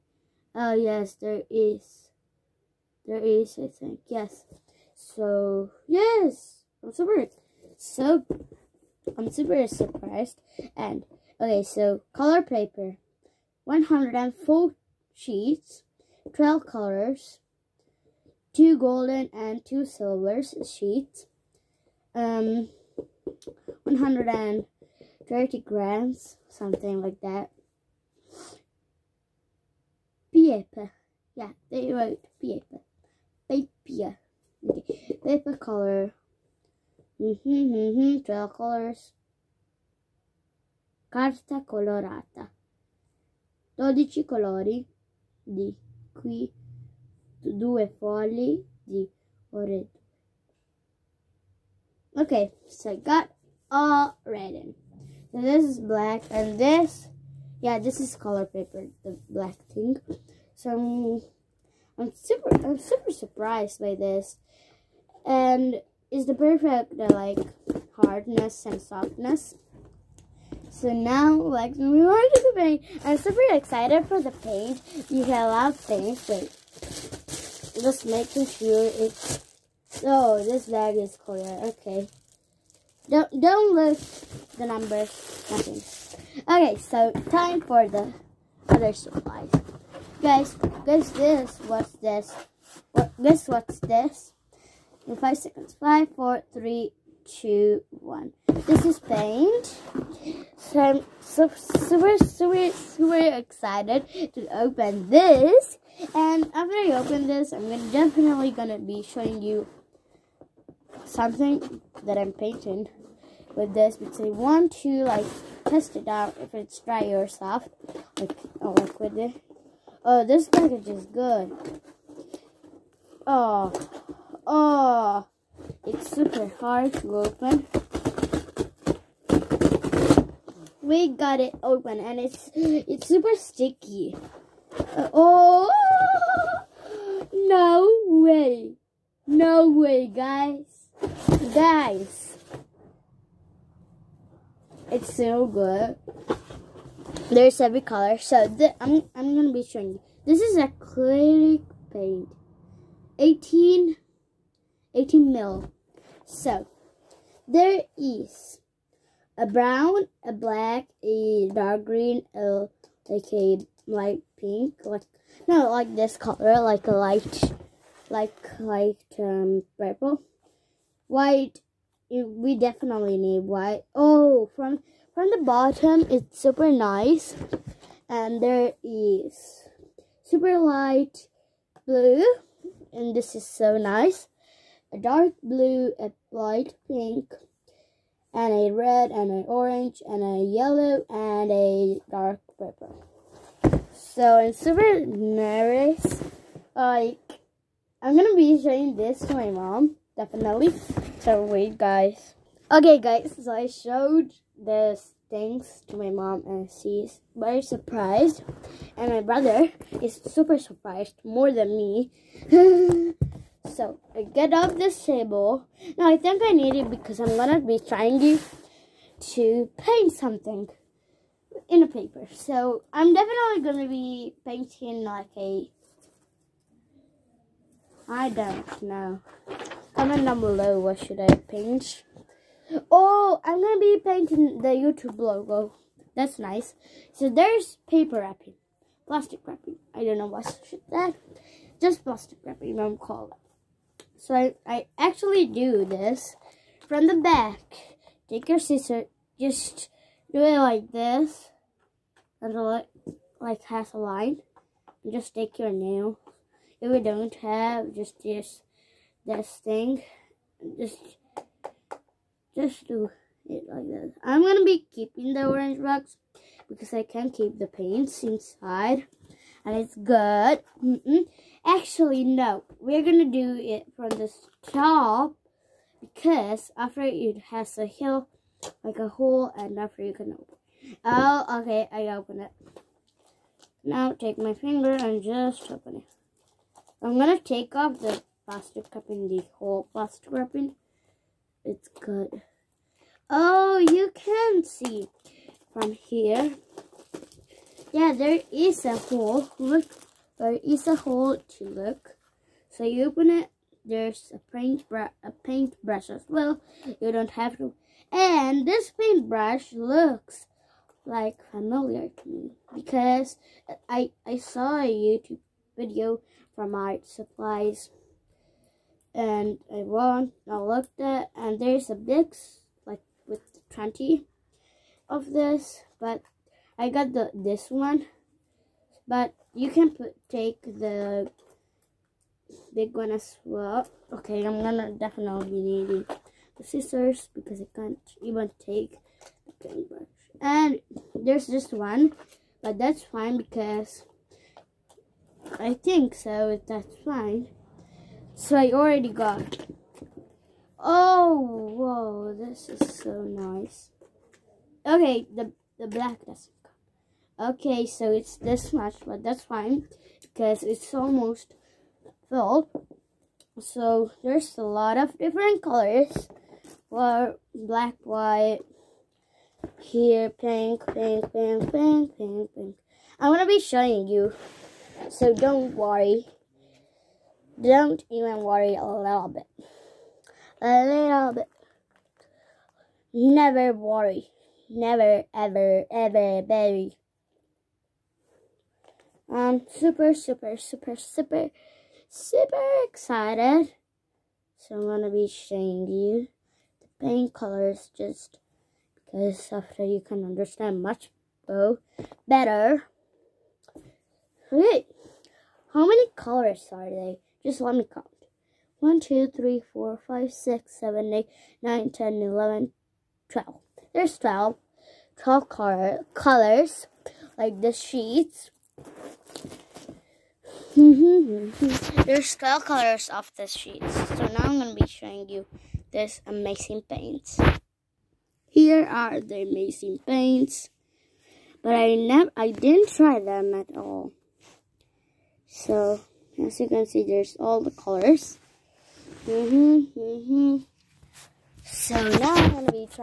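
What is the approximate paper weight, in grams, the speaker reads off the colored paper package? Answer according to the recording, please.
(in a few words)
130 grams.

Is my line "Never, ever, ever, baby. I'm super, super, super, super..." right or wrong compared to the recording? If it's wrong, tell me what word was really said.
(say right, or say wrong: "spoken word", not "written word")
right.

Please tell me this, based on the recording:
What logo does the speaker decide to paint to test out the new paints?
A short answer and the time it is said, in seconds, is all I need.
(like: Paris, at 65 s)
YouTube logo, at 234 s.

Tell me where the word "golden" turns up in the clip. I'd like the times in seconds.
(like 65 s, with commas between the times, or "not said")
18 s.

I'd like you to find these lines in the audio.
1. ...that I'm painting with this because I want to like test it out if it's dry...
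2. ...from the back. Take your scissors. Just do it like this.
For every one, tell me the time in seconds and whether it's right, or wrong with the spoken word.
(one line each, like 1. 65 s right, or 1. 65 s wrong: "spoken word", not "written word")
1. 112 s right
2. 246 s right.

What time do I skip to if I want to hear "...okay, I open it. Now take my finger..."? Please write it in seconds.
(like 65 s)
281 s.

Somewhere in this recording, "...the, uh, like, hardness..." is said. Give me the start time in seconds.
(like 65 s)
66 s.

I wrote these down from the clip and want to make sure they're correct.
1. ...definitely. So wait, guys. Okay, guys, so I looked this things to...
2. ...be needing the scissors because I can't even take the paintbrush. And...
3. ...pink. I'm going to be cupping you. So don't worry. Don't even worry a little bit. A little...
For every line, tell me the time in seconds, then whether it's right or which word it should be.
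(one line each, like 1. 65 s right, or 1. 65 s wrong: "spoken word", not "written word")
1. 200 s wrong: "showed", not "looked"
2. 335 s right
3. 372 s wrong: "showing", not "cupping".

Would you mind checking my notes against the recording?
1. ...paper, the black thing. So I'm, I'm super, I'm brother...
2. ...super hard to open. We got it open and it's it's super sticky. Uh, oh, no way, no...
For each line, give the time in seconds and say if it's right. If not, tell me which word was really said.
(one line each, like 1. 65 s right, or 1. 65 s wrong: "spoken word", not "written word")
1. 58 s wrong: "super", not "brother"
2. 126 s right.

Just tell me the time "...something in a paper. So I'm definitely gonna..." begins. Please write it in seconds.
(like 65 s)
220 s.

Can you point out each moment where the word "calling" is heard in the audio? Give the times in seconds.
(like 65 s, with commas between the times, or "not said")
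242 s.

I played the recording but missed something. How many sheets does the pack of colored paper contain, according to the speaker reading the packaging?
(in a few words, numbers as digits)
104.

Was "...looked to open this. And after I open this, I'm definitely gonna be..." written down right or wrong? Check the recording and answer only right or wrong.
wrong.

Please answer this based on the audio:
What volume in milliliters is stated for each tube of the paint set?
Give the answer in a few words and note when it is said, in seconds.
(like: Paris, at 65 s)
18 ml, at 154 s.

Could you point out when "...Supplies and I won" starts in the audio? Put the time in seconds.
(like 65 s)
317 s.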